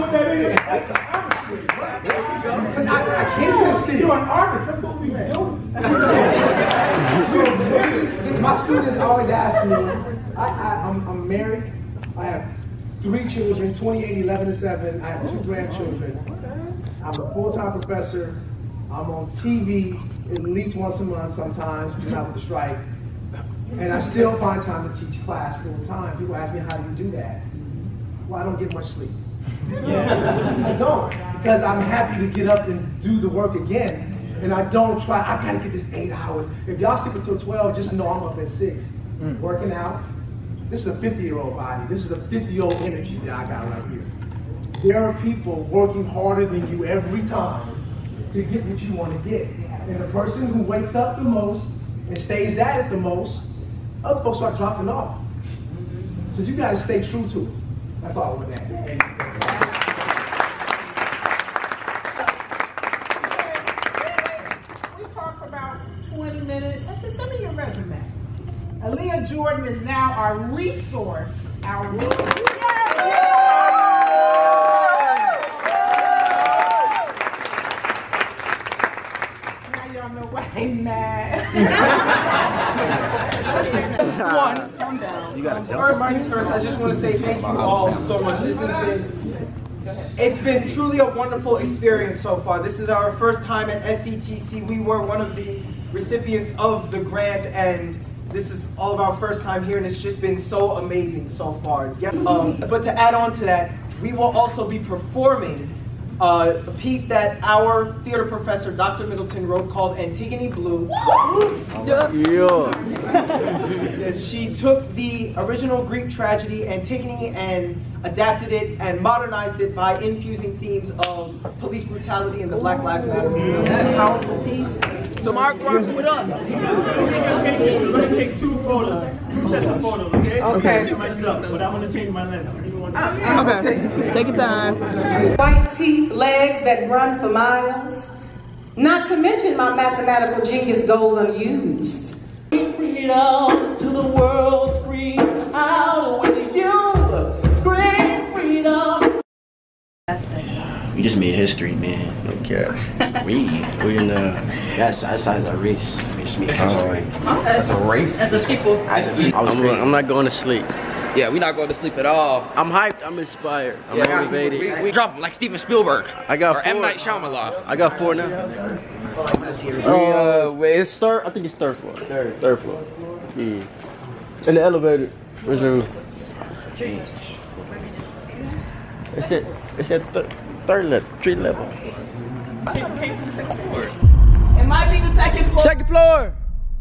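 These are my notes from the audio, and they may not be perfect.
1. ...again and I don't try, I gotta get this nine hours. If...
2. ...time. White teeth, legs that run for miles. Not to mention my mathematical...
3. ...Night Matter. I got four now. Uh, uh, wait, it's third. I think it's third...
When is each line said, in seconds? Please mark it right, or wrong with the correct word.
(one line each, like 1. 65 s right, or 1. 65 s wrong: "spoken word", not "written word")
1. 33 s wrong: "eight", not "nine"
2. 134 s right
3. 166 s wrong: "Shyamalan", not "Matter".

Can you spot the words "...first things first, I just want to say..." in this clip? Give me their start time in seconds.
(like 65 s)
85 s.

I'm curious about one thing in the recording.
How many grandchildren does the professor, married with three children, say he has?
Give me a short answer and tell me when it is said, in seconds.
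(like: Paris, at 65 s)
2, at 15 s.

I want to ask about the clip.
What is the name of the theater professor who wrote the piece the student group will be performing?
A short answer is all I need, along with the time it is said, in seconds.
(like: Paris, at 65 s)
Dr. Middleton, at 108 s.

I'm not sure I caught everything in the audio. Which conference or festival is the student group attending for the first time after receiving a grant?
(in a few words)
SETC.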